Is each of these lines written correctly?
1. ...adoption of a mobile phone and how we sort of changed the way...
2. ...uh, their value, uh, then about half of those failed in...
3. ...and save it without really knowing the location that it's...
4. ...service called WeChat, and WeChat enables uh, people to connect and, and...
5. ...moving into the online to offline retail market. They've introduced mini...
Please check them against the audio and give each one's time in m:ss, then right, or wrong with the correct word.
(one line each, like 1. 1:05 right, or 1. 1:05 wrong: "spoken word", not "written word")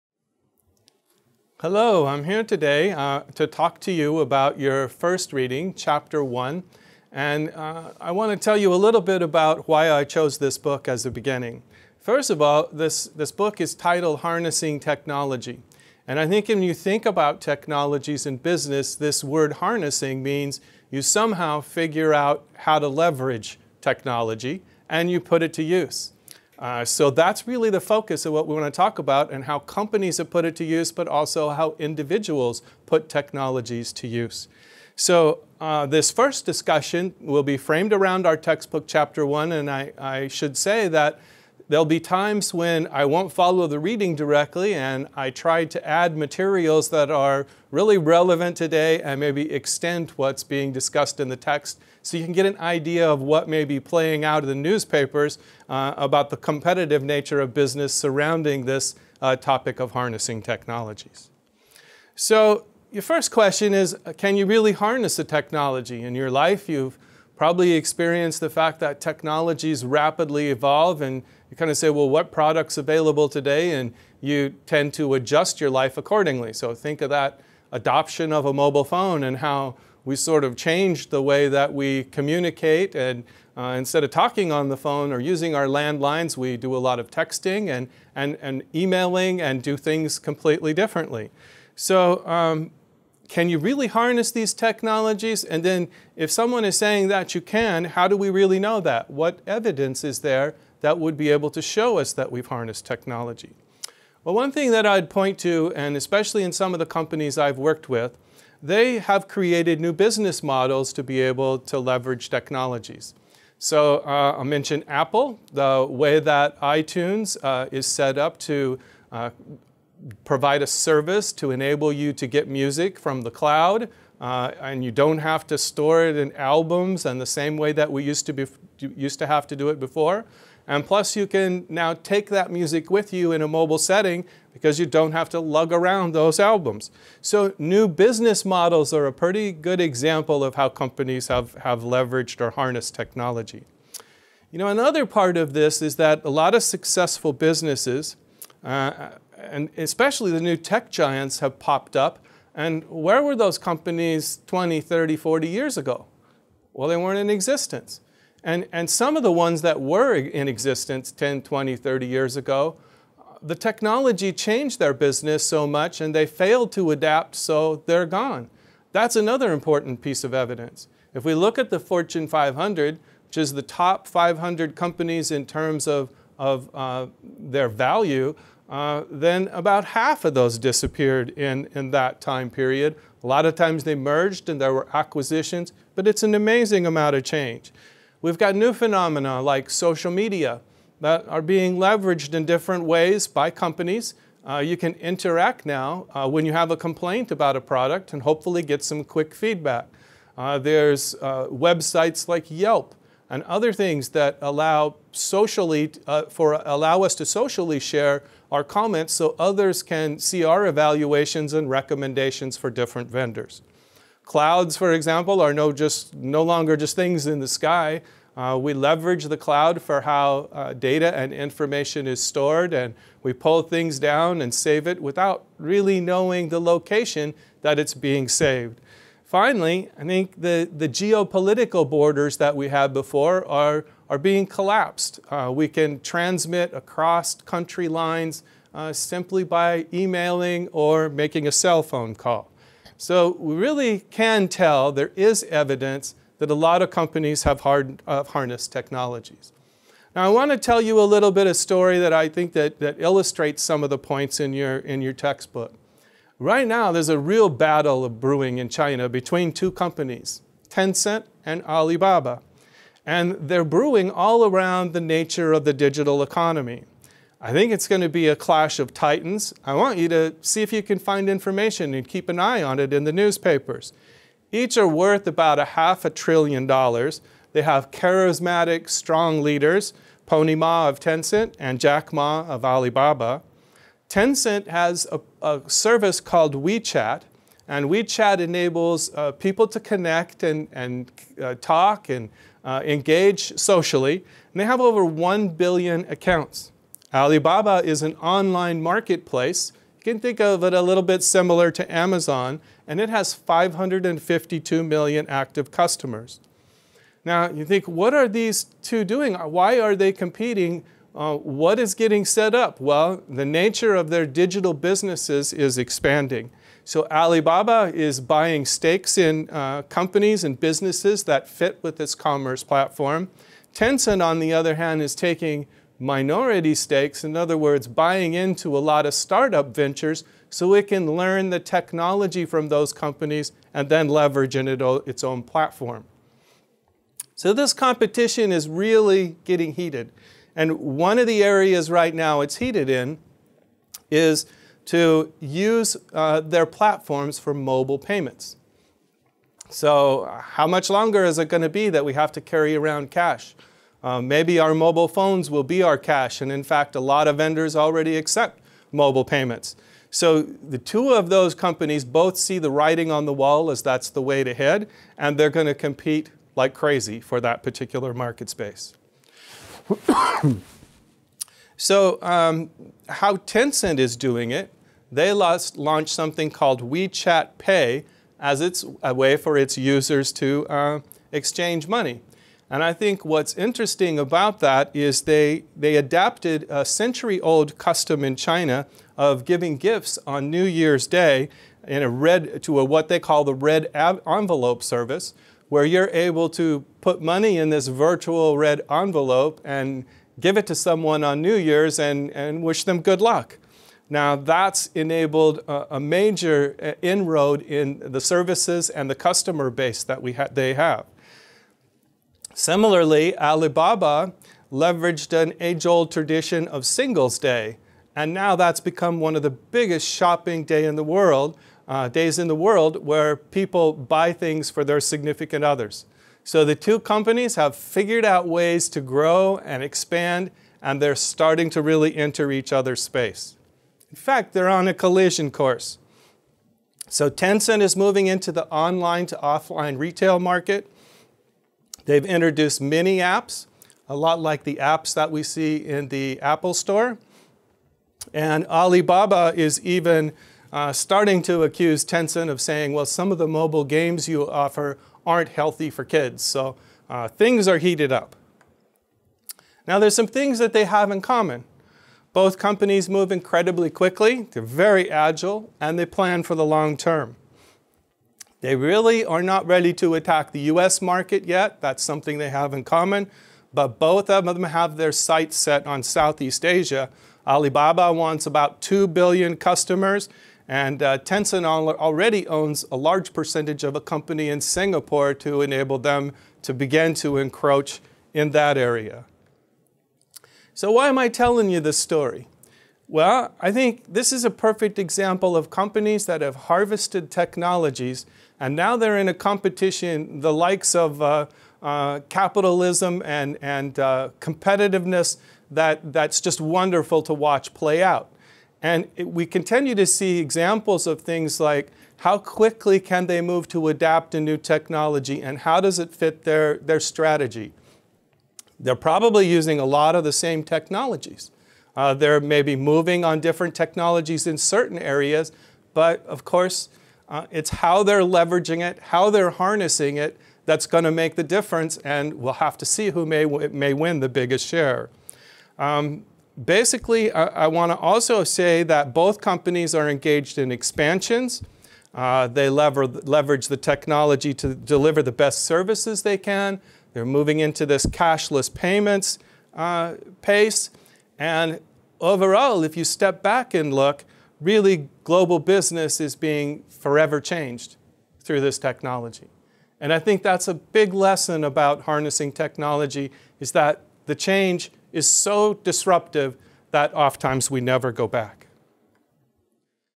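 1. 1:17 right
2. 2:56 wrong: "disappeared", not "failed"
3. 3:44 right
4. 4:45 right
5. 7:17 right.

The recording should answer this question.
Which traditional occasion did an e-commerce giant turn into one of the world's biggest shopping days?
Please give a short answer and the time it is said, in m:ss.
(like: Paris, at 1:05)
Singles Day, at 6:56.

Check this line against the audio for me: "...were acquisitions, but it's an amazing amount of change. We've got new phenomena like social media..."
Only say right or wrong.
right.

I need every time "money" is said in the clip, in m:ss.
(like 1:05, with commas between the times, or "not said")
6:21, 6:37.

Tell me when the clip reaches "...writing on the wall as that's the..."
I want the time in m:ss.
6:02.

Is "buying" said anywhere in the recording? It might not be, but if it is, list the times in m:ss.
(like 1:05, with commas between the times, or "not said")
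5:18, 5:27.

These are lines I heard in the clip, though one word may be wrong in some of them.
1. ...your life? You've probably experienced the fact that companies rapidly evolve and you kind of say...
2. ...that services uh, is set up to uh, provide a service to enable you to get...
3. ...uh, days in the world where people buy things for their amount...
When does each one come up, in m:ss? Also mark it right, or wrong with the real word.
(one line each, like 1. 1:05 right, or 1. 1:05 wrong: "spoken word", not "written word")
1. 1:06 wrong: "technologies", not "companies"
2. 1:56 wrong: "iTunes", not "services"
3. 7:01 wrong: "significant", not "amount".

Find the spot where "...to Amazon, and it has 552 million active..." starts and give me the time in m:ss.
5:01.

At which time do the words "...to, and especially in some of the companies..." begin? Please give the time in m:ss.
1:45.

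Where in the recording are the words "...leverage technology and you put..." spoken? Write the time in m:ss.
0:22.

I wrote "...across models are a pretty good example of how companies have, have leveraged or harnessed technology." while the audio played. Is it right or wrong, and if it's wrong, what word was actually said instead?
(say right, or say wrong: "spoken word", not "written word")
wrong: "business", not "across".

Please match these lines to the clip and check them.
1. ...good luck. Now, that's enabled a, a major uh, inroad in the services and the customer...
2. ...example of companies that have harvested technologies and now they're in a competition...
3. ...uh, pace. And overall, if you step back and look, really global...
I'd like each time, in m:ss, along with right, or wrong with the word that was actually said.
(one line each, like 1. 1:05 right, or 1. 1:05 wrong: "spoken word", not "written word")
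1. 6:43 right
2. 8:14 right
3. 9:09 right.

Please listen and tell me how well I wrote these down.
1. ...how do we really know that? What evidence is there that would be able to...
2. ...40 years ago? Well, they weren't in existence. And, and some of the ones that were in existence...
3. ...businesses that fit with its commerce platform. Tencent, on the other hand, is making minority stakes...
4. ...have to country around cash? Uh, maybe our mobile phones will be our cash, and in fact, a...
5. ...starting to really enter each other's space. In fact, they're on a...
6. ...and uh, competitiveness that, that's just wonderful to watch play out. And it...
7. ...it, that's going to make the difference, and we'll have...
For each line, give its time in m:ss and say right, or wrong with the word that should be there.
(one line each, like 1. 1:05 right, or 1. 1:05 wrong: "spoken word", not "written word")
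1. 1:37 right
2. 2:35 right
3. 5:20 wrong: "taking", not "making"
4. 5:52 wrong: "carry", not "country"
5. 7:11 right
6. 8:23 right
7. 8:50 right.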